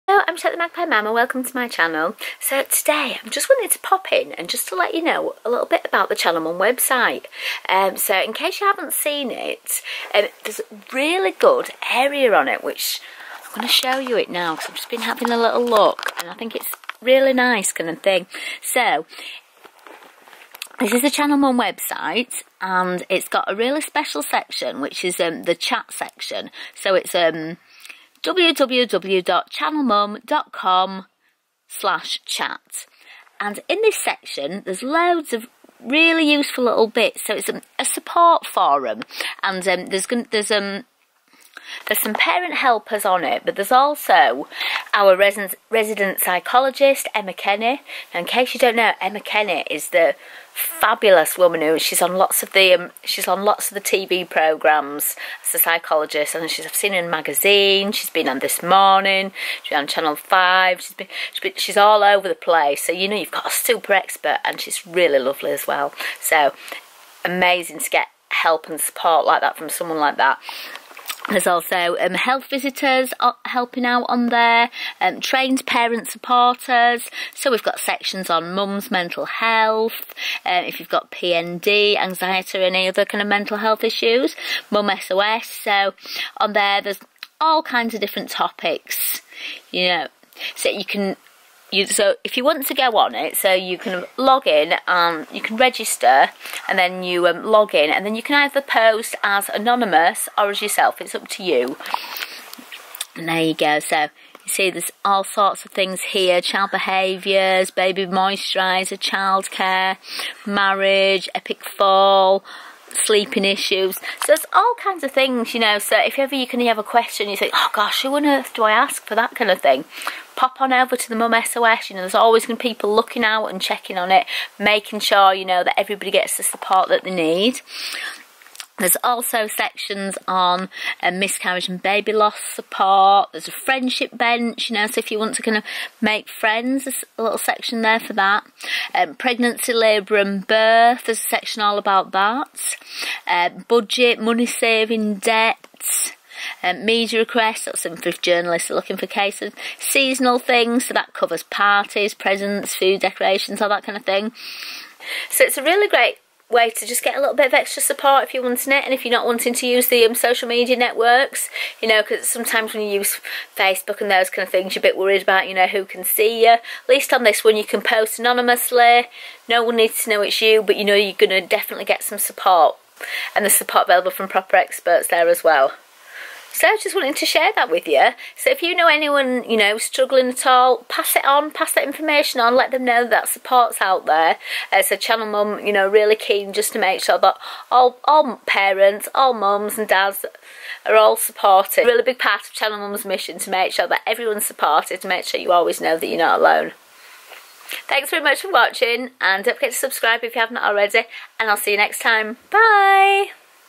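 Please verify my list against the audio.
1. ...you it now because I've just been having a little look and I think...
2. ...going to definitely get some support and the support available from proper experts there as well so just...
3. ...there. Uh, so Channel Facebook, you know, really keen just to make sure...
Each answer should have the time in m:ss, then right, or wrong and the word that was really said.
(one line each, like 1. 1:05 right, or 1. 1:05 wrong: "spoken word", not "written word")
1. 0:13 right
2. 2:51 right
3. 3:04 wrong: "Mum", not "Facebook".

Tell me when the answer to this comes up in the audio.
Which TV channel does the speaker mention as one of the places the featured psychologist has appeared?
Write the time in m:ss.
0:59.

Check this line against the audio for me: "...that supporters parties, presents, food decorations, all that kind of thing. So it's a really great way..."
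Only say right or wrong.
wrong.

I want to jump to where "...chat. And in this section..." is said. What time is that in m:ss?
0:32.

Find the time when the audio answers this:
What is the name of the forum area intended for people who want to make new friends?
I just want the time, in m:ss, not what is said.
2:13.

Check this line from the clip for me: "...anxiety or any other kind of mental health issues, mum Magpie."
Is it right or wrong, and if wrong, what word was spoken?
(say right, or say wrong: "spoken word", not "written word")
wrong: "SOS", not "Magpie".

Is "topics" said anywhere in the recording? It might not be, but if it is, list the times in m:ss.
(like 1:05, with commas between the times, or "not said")
1:28.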